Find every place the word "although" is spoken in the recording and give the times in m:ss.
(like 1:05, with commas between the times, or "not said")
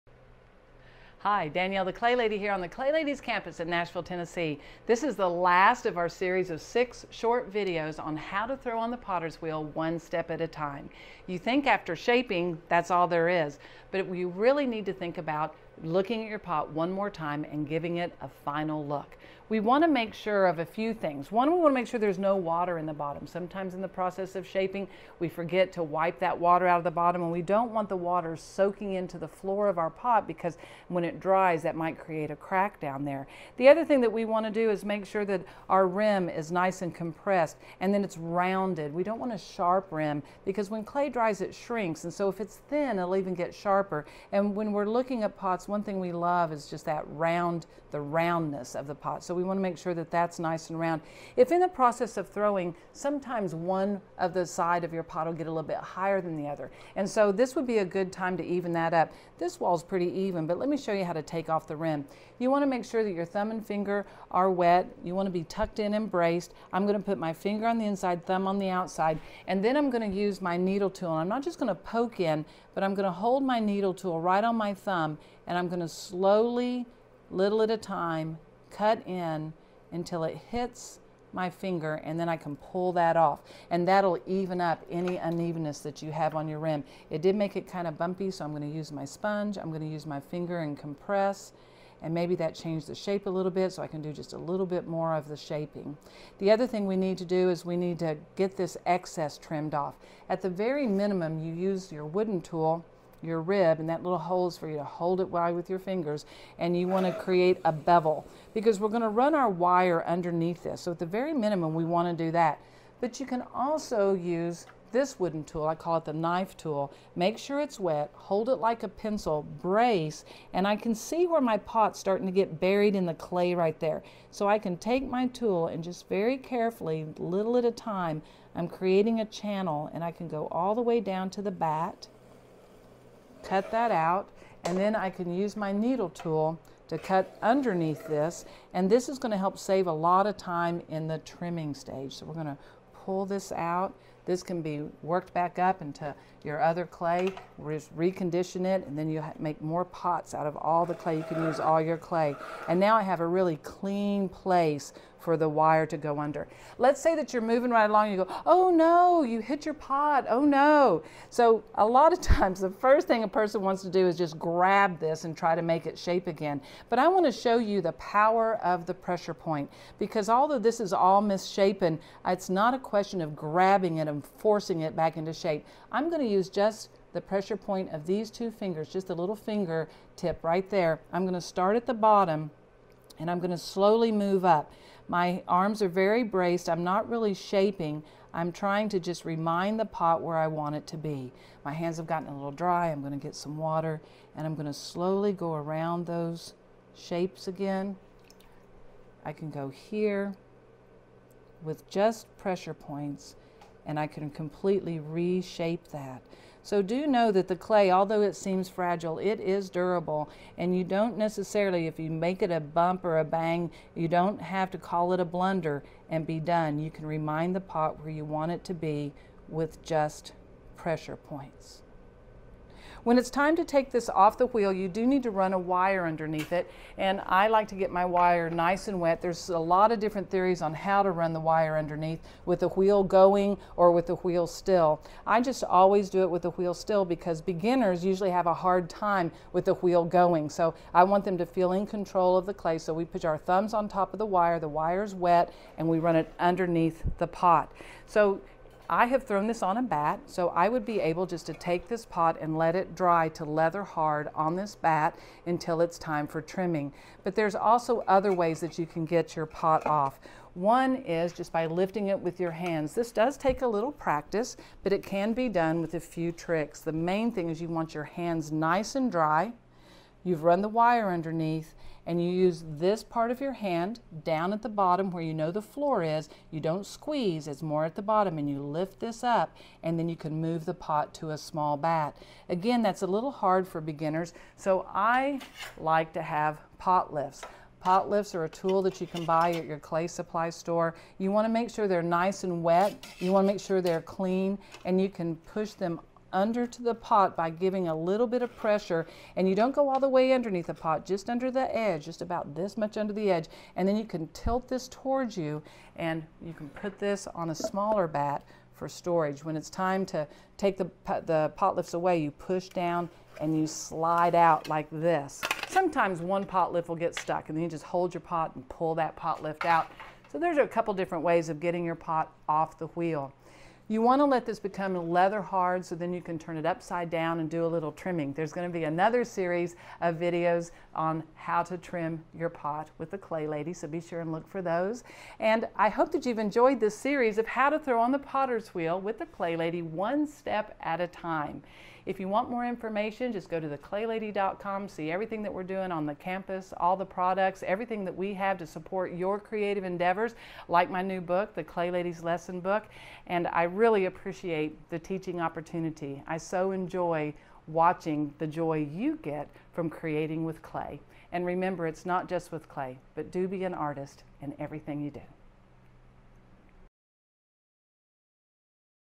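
2:50, 3:27.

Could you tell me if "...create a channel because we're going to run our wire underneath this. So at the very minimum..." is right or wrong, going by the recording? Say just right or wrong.
wrong.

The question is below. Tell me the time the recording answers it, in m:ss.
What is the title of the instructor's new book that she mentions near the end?
5:51.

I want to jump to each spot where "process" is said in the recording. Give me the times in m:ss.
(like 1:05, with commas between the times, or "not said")
0:23, 0:51.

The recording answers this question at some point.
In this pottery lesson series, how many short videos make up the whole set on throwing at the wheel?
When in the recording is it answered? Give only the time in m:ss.
0:06.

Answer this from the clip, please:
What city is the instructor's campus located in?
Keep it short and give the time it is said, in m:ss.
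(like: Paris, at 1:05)
Nashville, at 0:03.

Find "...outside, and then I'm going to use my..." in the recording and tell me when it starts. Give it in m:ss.
1:08.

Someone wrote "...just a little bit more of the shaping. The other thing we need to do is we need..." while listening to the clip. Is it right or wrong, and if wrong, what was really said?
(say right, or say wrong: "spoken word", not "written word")
right.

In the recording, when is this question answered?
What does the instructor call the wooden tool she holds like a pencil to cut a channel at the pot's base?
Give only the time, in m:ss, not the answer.
1:56.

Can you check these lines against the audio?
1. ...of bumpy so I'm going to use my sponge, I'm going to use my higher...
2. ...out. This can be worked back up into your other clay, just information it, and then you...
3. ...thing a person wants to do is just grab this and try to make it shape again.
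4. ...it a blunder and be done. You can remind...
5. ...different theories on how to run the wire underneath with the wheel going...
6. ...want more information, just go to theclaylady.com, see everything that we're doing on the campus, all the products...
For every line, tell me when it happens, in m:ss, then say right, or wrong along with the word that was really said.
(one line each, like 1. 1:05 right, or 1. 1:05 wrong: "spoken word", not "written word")
1. 1:27 wrong: "finger", not "higher"
2. 2:23 wrong: "recondition", not "information"
3. 2:43 right
4. 3:35 right
5. 3:49 right
6. 5:42 right.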